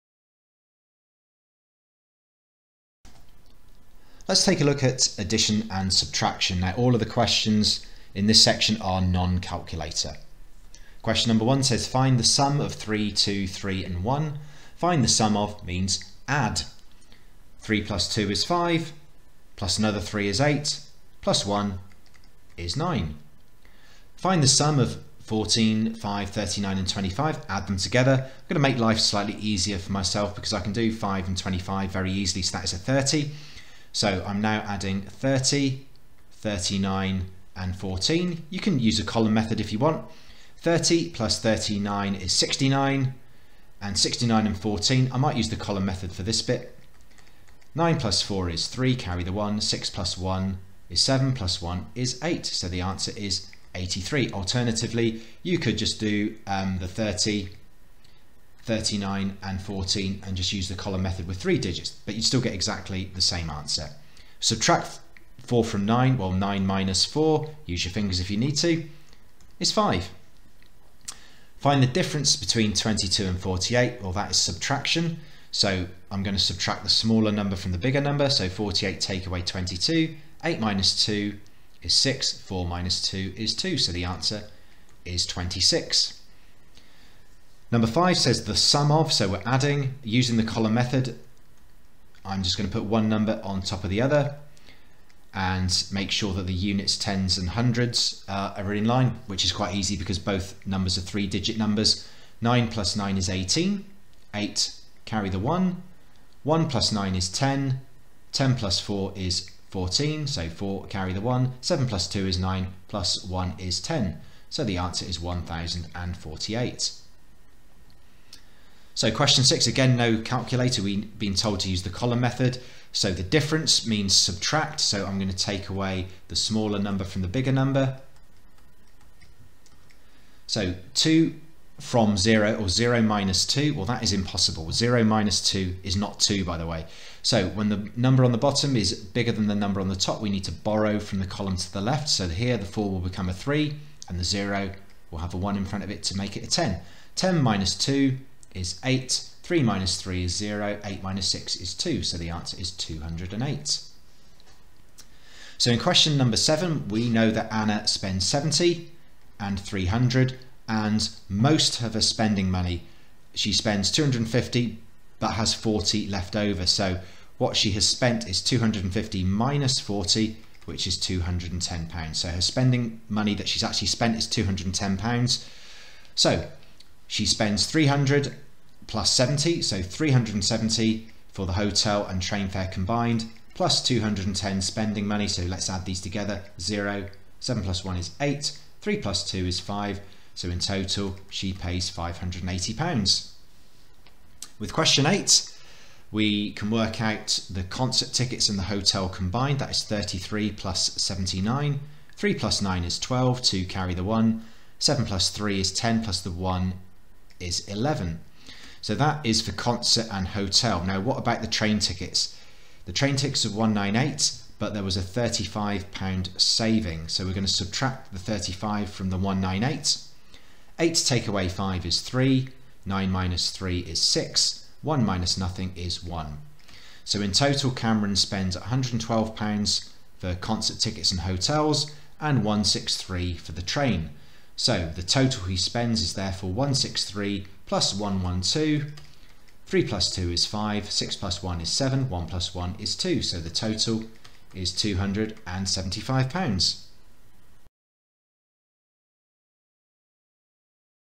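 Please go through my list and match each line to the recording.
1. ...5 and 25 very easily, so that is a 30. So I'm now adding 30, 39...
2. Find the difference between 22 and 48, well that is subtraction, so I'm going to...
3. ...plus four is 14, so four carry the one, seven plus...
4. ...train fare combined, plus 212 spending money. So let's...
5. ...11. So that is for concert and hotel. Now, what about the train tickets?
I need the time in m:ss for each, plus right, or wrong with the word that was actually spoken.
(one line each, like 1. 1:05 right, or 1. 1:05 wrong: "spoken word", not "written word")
1. 0:30 right
2. 1:11 right
3. 1:48 right
4. 3:02 wrong: "210", not "212"
5. 3:27 right.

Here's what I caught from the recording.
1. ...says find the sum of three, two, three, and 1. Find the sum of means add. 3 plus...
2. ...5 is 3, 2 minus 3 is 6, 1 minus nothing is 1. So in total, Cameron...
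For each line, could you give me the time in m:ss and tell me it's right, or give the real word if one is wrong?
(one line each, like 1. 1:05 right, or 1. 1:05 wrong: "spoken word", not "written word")
1. 0:11 right
2. 3:41 wrong: "9", not "2".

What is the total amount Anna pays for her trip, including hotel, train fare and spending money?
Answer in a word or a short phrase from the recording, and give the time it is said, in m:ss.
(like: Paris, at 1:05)
580 pounds, at 3:11.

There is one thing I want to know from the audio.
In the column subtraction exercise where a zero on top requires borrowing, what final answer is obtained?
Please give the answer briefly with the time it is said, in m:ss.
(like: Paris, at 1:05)
208, at 2:32.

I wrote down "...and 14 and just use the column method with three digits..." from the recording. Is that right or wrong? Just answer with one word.
right.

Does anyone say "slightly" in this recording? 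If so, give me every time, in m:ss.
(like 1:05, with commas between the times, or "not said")
0:28.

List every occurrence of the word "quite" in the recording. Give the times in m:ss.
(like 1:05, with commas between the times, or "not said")
1:39.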